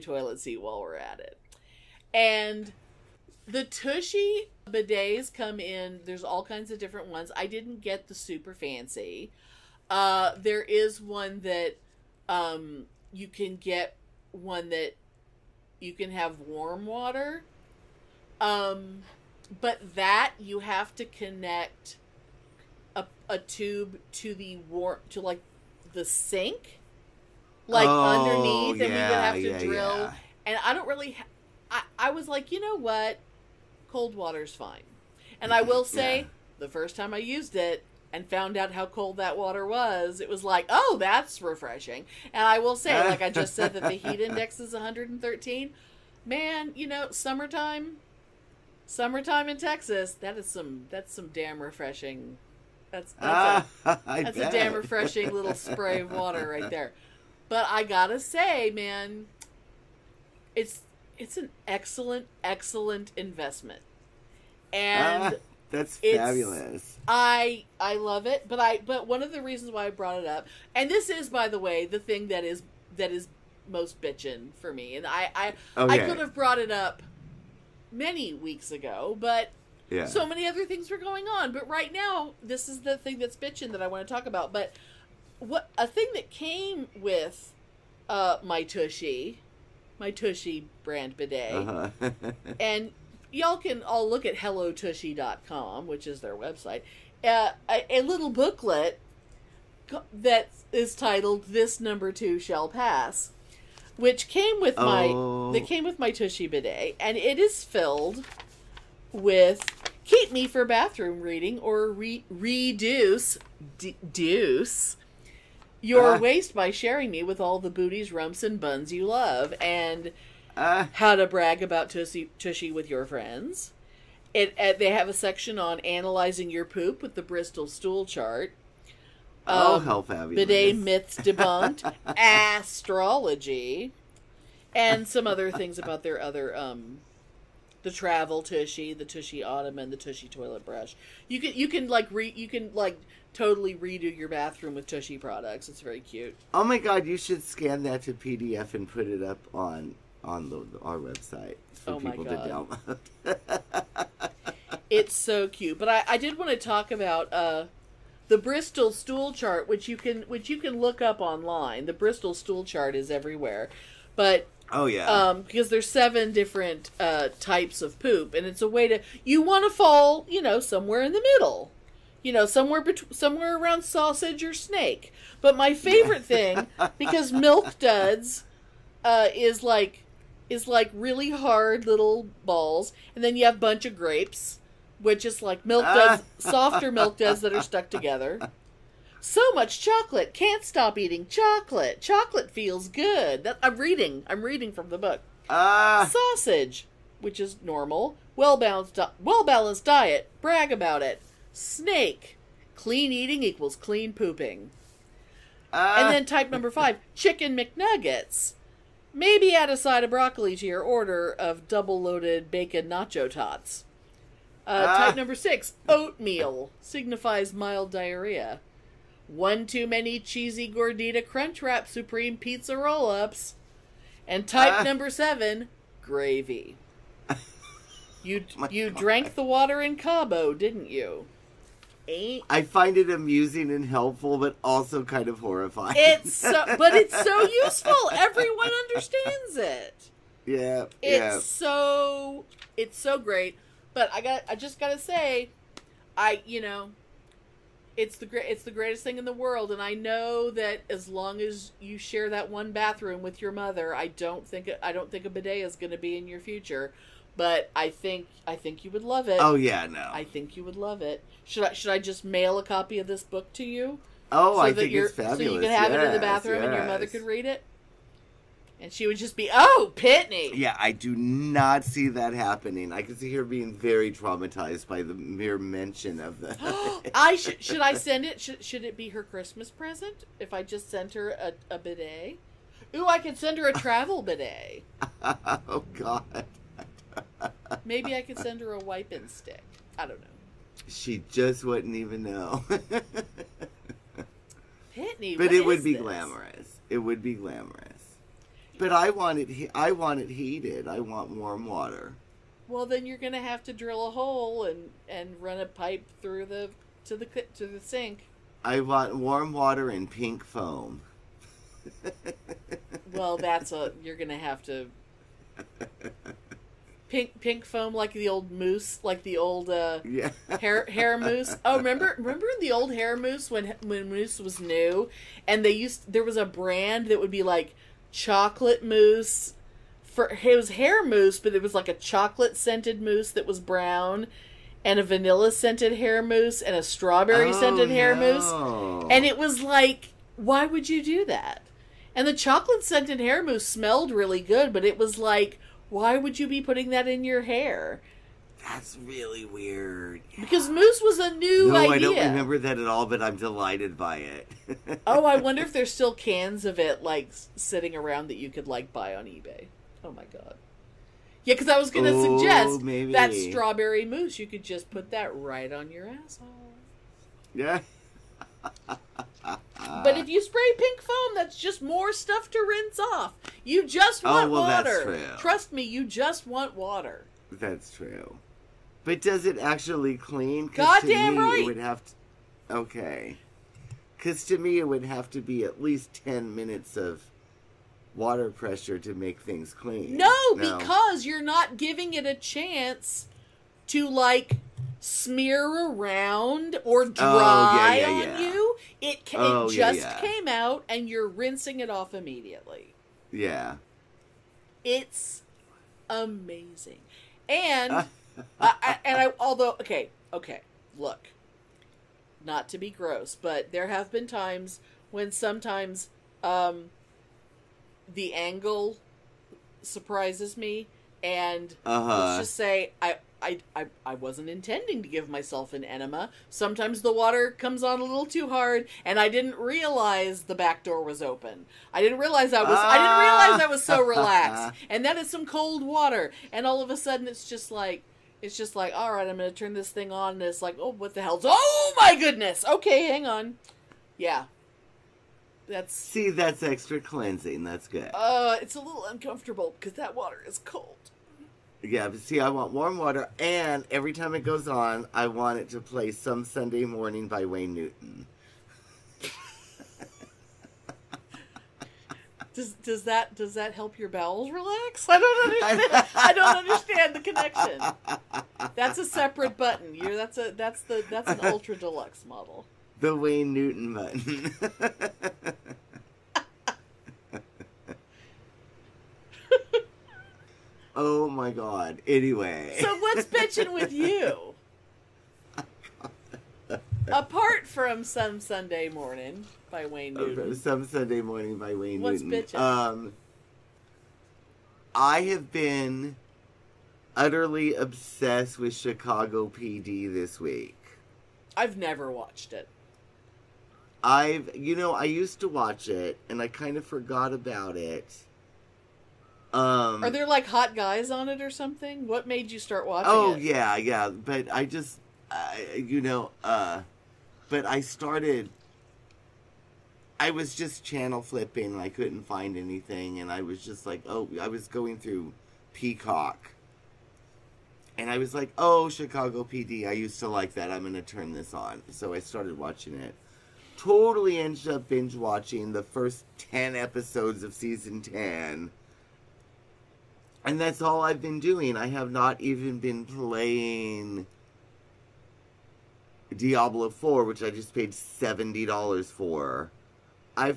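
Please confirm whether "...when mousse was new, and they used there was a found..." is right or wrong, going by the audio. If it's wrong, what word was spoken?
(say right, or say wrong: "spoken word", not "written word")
wrong: "brand", not "found".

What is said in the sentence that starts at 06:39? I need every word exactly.
It, ca- oh, it just came out and you're rinsing it off immediately.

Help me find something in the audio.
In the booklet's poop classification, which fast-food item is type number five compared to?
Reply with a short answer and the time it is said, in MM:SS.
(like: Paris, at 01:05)
Chicken McNuggets, at 03:27.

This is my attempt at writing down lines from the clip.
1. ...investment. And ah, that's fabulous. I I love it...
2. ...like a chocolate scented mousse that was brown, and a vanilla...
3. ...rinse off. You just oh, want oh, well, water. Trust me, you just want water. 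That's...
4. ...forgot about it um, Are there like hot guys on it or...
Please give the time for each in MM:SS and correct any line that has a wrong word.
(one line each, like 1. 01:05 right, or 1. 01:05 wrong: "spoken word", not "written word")
1. 01:03 right
2. 05:31 right
3. 06:12 right
4. 08:26 right.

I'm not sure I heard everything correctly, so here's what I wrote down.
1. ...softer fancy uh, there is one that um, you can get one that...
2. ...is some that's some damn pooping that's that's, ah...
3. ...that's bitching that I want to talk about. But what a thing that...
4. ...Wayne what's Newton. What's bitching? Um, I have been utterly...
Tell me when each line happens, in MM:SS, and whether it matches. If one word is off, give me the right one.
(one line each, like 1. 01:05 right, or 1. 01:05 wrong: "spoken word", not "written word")
1. 00:08 wrong: "super", not "softer"
2. 00:50 wrong: "refreshing", not "pooping"
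3. 01:23 right
4. 08:11 right.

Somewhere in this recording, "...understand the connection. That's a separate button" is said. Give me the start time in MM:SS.
07:46.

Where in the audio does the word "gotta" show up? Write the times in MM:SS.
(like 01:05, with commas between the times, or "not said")
00:57, 04:04.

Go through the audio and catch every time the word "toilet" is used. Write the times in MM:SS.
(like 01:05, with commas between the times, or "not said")
00:00, 02:20.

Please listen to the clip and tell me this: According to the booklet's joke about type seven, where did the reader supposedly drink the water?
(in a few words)
Cabo.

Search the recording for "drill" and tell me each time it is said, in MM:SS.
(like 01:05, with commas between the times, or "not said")
00:29, 05:03.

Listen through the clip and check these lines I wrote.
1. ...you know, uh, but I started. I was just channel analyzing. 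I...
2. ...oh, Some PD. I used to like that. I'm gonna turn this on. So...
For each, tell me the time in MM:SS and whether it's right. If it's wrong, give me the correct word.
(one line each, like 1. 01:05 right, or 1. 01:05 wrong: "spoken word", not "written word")
1. 08:35 wrong: "flipping", not "analyzing"
2. 08:48 wrong: "Chicago", not "Some".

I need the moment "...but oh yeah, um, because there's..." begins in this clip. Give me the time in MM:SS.
02:44.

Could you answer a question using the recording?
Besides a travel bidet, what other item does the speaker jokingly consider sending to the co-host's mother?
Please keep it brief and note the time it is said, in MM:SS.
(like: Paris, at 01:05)
A wiping stick, at 04:48.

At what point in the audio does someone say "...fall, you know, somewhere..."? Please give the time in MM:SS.
02:49.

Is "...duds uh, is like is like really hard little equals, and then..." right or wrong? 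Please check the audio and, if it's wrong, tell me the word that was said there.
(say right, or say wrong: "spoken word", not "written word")
wrong: "balls", not "equals".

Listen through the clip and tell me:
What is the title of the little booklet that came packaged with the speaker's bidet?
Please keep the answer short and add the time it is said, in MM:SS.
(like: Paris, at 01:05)
This Number Two Shall Pass, at 01:41.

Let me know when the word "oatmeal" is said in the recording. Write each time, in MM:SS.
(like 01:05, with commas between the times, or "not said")
03:35.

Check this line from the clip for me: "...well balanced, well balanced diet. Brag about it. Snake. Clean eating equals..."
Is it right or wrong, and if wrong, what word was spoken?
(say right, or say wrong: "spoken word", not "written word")
right.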